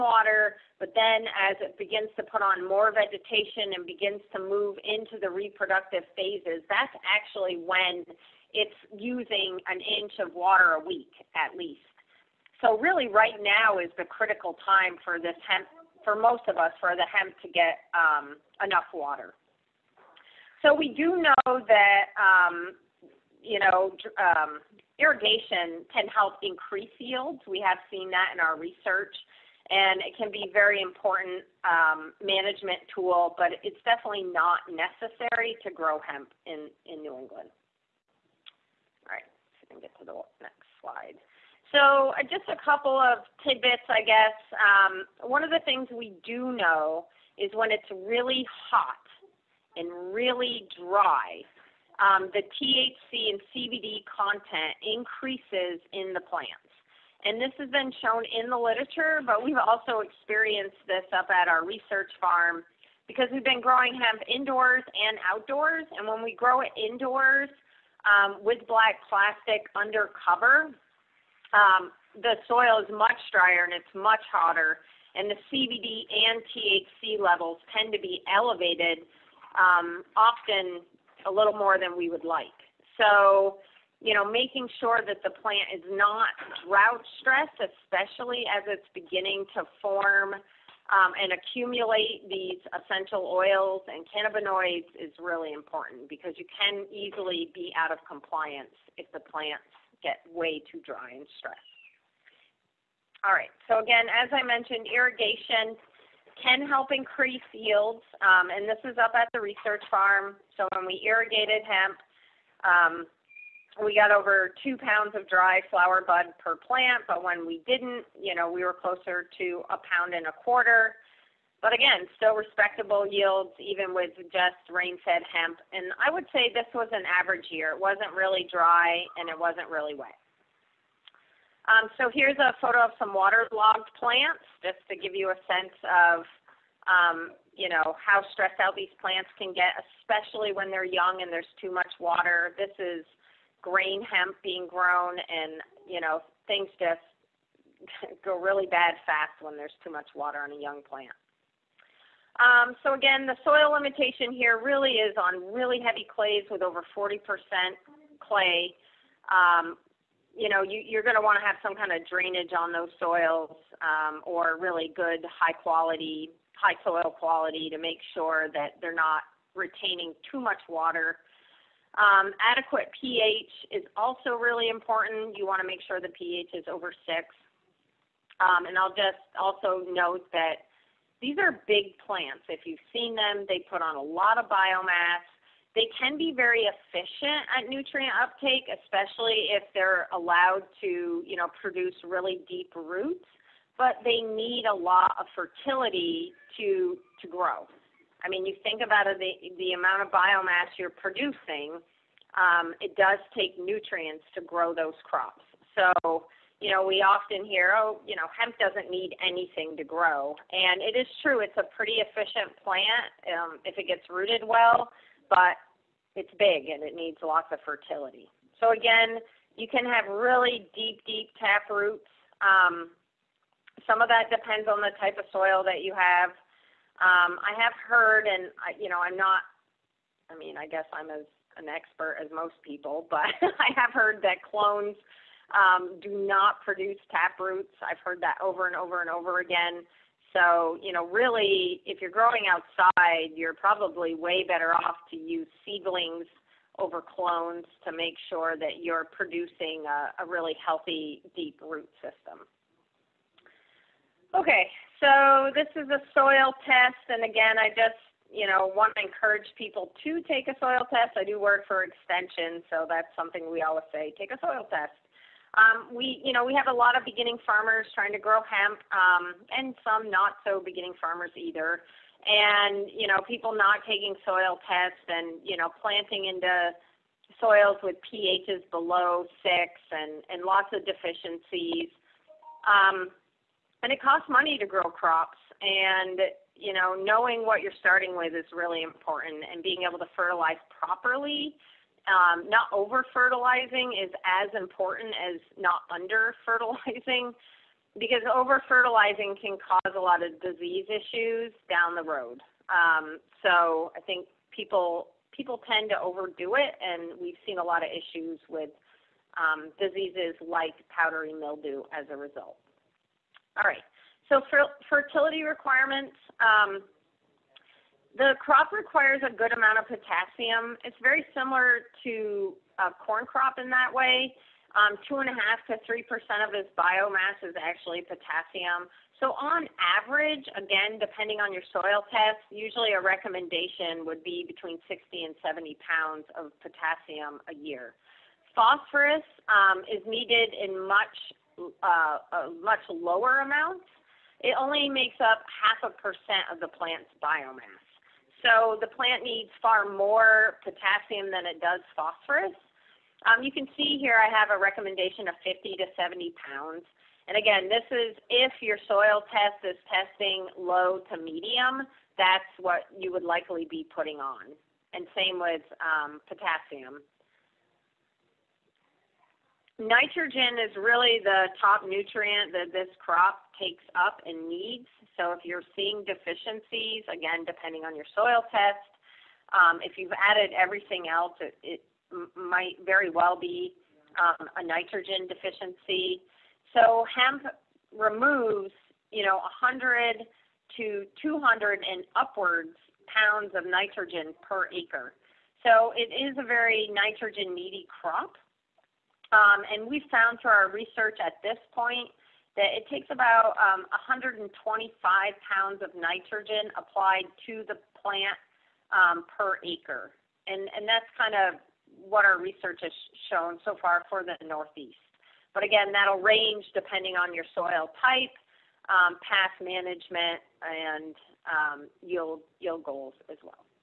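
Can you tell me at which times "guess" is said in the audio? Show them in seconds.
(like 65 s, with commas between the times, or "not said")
44 s, 230 s.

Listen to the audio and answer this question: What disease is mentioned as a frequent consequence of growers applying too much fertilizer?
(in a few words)
powdery mildew.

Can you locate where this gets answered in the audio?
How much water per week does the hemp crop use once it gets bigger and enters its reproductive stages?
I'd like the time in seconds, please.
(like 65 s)
9 s.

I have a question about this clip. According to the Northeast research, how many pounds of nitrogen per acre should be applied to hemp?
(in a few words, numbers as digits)
125 pounds.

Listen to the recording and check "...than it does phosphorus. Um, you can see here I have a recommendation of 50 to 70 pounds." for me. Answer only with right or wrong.
right.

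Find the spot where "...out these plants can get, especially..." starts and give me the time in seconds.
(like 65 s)
138 s.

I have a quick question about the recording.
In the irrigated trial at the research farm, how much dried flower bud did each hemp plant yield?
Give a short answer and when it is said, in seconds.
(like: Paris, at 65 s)
over 2 pounds, at 114 s.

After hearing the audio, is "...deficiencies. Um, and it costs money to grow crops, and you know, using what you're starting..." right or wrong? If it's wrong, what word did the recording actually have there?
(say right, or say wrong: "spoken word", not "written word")
wrong: "knowing", not "using".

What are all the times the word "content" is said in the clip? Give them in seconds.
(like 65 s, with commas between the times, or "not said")
54 s.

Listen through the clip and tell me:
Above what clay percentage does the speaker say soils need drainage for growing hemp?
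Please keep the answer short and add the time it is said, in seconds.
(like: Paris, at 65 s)
40%, at 156 s.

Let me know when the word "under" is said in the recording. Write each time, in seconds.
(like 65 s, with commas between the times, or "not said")
69 s, 295 s.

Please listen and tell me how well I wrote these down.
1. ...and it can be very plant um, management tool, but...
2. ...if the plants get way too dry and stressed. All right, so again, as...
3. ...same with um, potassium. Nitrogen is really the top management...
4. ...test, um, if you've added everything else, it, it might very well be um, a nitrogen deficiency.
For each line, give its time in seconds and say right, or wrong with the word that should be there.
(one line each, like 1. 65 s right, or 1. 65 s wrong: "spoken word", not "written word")
1. 29 s wrong: "important", not "plant"
2. 98 s right
3. 365 s wrong: "nutrient", not "management"
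4. 378 s right.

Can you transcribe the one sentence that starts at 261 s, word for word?
I do work for extension, so that's something we always say, take a soil test.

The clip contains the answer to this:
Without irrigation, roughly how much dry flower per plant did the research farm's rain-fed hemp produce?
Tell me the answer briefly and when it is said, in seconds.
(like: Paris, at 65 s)
1.25 pounds, at 119 s.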